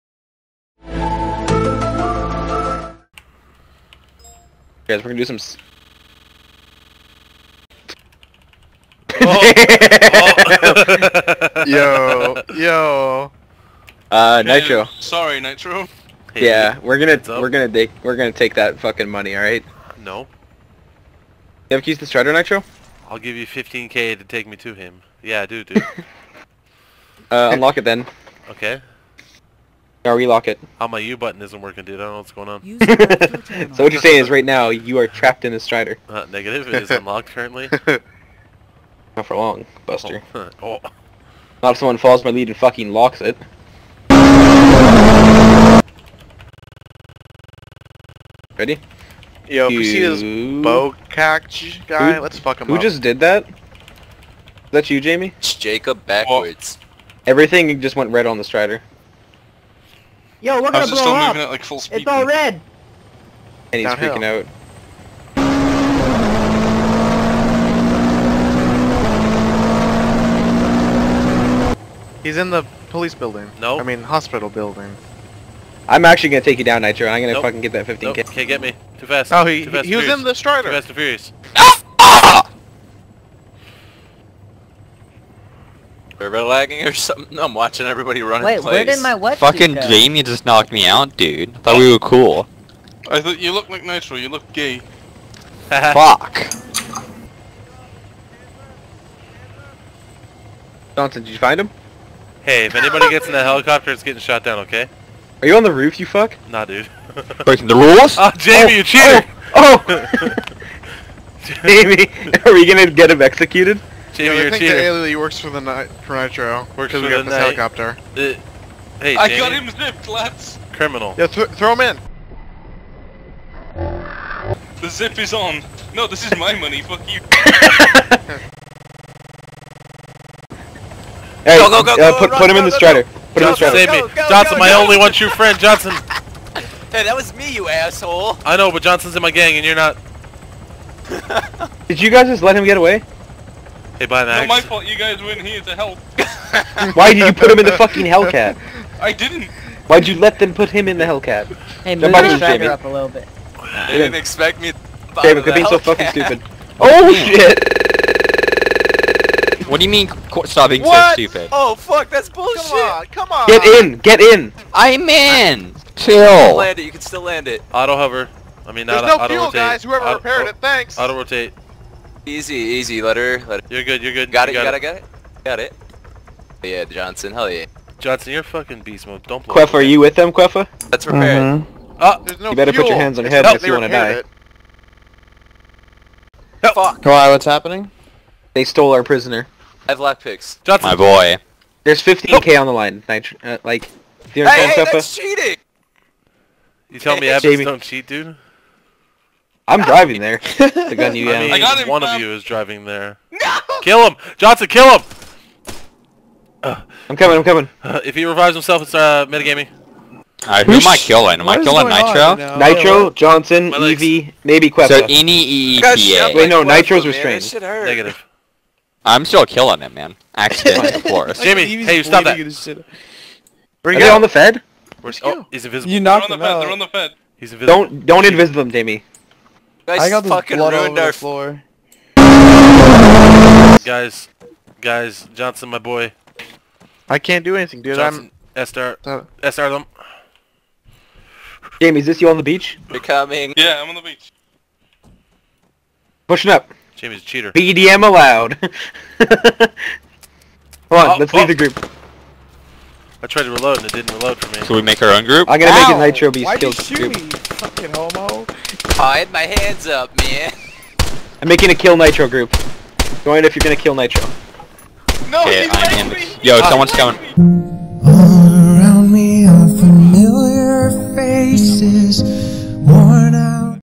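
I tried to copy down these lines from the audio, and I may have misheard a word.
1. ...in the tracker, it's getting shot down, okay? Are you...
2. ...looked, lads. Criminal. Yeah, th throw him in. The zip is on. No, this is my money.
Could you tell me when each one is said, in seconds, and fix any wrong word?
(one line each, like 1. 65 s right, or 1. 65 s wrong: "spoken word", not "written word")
1. 103 s wrong: "helicopter", not "tracker"
2. 119 s wrong: "zipped", not "looked".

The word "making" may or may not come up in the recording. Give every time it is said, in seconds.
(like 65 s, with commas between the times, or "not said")
261 s.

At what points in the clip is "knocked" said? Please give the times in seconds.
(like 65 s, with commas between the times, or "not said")
90 s, 226 s.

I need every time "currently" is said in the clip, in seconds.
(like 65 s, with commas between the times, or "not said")
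37 s.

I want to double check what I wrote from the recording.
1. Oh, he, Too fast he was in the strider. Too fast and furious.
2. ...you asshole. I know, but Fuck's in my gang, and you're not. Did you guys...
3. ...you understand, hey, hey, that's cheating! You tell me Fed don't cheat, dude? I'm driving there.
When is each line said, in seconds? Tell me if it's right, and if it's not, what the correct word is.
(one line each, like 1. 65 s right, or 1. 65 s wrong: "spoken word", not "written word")
1. 79 s right
2. 137 s wrong: "Johnson", not "Fuck"
3. 194 s wrong: "Abbots", not "Fed".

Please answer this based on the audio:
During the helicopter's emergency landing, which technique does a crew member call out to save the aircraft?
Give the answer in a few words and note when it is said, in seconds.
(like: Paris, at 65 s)
Auto rotate, at 170 s.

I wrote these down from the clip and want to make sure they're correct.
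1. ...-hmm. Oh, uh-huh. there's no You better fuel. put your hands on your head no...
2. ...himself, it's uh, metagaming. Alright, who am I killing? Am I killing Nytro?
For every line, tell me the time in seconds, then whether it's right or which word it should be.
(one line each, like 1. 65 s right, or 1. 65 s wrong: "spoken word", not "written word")
1. 181 s right
2. 208 s right.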